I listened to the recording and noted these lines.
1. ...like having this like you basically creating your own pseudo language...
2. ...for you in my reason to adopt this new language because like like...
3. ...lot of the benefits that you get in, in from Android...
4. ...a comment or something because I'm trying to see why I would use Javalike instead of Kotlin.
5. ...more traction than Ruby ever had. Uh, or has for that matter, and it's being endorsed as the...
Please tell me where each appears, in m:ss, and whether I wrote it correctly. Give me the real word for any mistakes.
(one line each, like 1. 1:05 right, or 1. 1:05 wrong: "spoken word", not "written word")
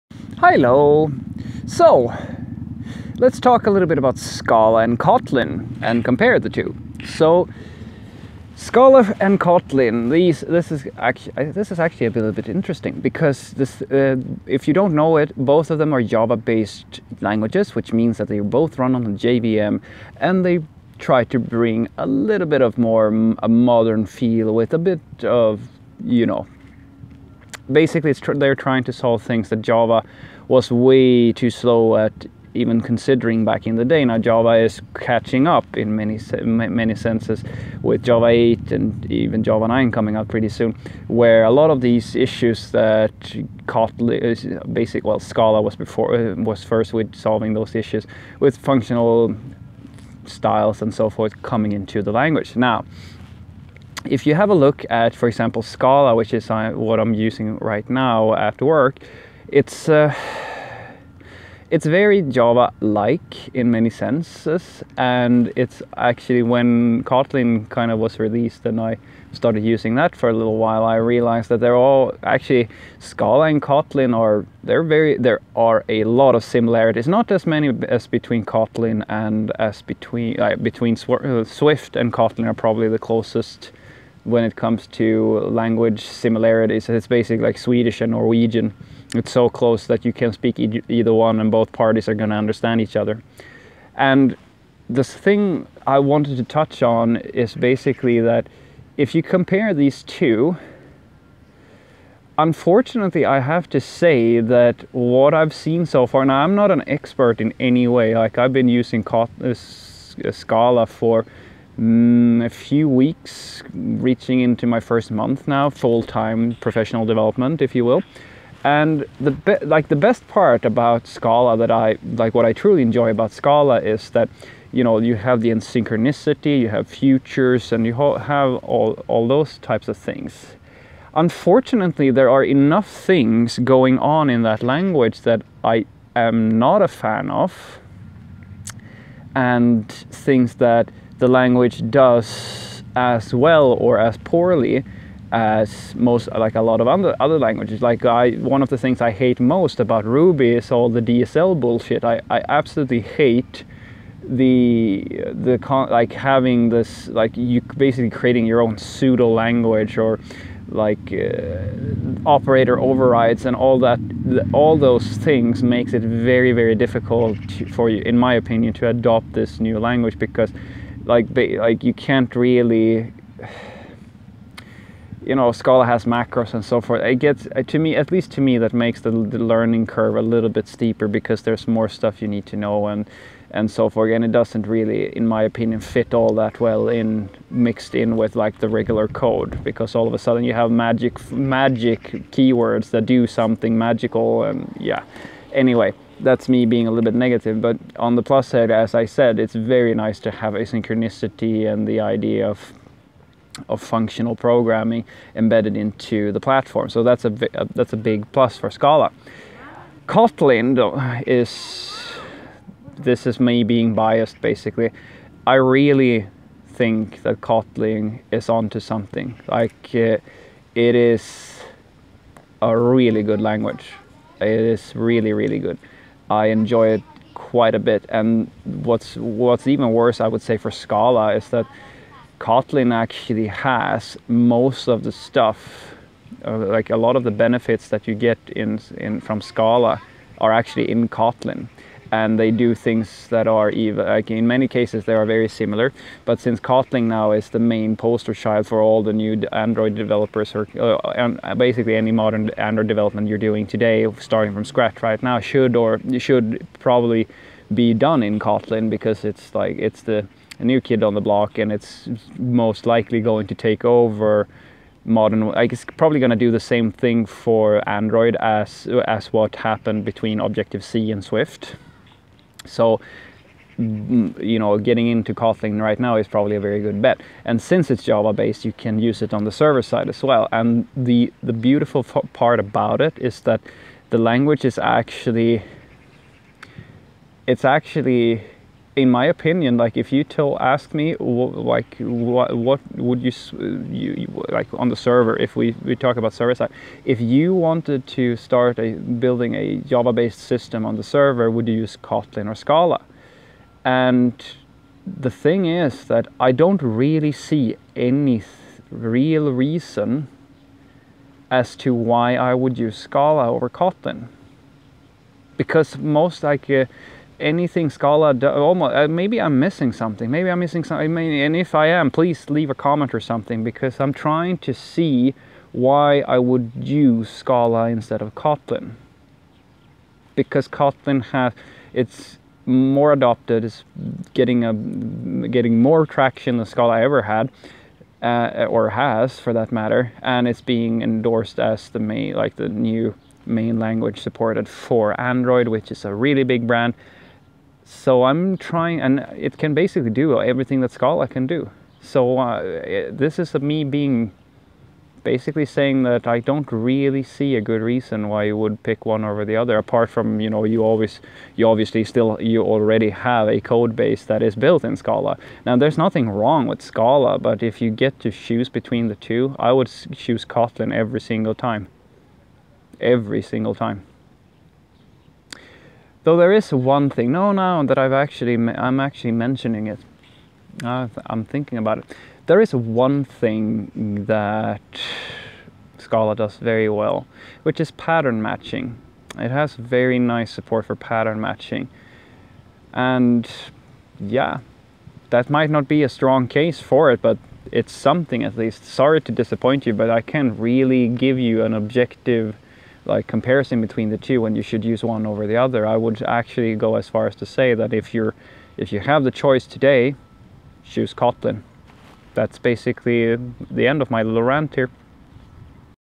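1. 2:35 right
2. 2:47 wrong: "opinion", not "reason"
3. 3:56 wrong: "Scala", not "Android"
4. 5:22 wrong: "Scala", not "Javalike"
5. 5:35 wrong: "Scala", not "Ruby".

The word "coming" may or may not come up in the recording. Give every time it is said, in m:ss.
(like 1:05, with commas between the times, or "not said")
0:39, 0:51.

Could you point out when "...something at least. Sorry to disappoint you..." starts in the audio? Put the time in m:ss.
6:37.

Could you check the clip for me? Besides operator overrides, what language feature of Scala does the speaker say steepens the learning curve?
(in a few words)
macros.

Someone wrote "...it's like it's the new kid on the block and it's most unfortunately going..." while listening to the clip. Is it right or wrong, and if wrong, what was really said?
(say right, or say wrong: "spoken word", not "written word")
wrong: "likely", not "unfortunately".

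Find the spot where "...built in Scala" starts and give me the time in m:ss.
6:04.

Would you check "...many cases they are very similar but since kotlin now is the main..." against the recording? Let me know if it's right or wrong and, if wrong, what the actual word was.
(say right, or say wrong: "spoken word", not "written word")
right.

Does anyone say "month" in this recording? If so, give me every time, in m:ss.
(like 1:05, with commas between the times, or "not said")
1:55.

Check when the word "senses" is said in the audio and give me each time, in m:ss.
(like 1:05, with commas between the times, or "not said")
0:36, 1:03.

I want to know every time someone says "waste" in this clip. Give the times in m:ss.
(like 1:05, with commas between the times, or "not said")
not said.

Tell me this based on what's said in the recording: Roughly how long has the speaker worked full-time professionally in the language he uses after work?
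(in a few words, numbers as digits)
a few weeks.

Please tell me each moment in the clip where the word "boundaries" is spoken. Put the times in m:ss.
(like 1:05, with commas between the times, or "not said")
not said.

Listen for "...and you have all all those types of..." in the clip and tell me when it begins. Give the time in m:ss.
2:07.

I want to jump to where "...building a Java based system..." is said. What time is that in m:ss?
4:58.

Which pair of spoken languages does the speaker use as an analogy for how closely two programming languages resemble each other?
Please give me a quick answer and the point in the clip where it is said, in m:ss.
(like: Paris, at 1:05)
Swedish and Norwegian, at 1:27.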